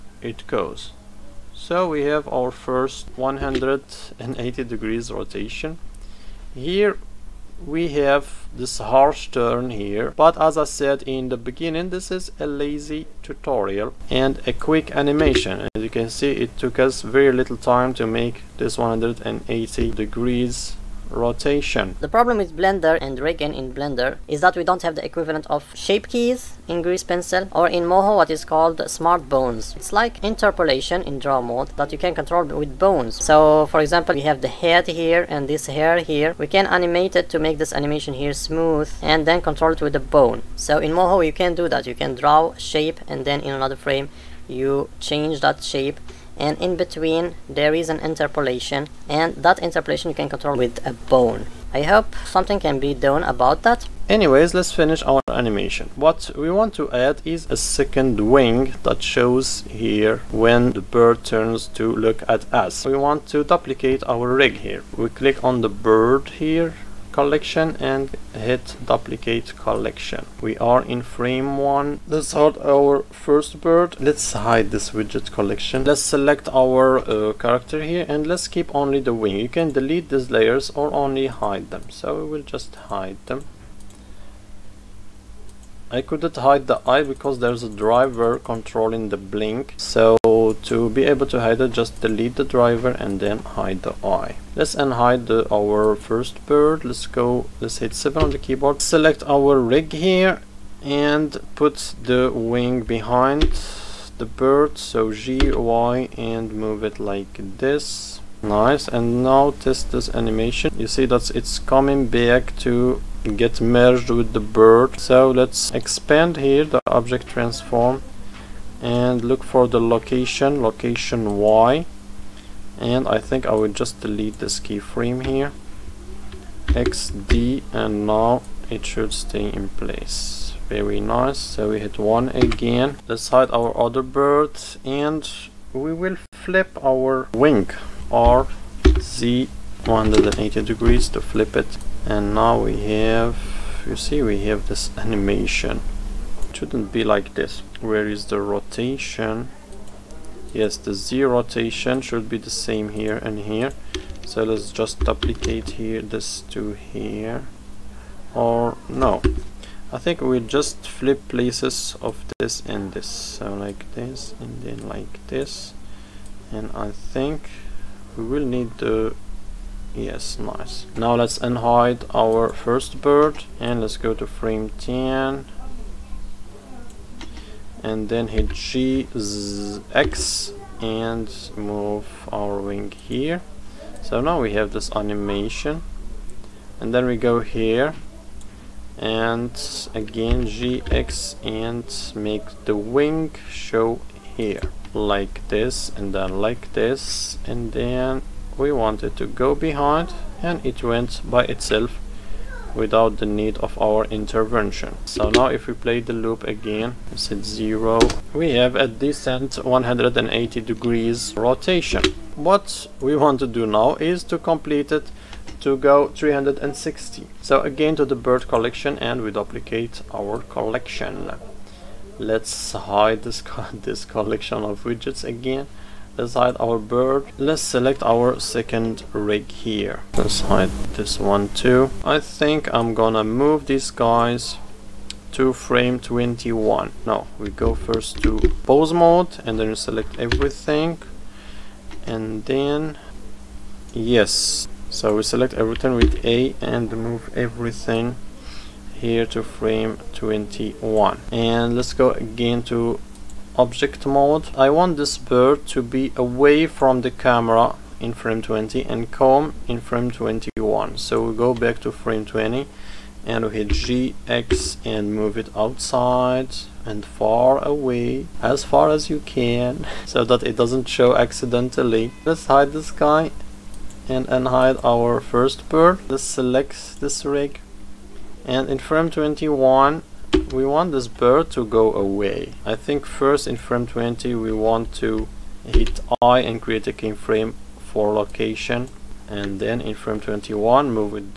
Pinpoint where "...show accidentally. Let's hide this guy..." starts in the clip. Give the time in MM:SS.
04:30.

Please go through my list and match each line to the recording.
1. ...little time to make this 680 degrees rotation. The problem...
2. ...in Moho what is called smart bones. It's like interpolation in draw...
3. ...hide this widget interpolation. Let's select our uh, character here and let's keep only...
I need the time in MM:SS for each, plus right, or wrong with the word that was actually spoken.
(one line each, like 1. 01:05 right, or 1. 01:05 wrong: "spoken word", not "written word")
1. 00:17 wrong: "180", not "680"
2. 00:27 right
3. 01:14 wrong: "collection", not "interpolation".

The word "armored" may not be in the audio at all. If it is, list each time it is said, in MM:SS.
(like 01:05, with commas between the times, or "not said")
not said.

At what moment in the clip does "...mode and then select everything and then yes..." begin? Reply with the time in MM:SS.
03:58.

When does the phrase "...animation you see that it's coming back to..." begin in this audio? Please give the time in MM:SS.
01:50.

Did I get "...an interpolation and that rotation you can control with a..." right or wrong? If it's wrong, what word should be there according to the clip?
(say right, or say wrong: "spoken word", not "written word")
wrong: "interpolation", not "rotation".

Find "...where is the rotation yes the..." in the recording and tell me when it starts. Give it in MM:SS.
02:27.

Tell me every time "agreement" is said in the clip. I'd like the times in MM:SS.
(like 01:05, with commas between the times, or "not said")
not said.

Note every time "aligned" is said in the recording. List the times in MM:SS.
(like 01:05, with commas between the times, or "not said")
not said.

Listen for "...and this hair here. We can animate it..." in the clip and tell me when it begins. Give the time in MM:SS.
00:35.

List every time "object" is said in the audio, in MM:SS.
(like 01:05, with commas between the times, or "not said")
01:56, 04:13.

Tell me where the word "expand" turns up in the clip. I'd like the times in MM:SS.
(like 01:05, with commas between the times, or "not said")
01:55.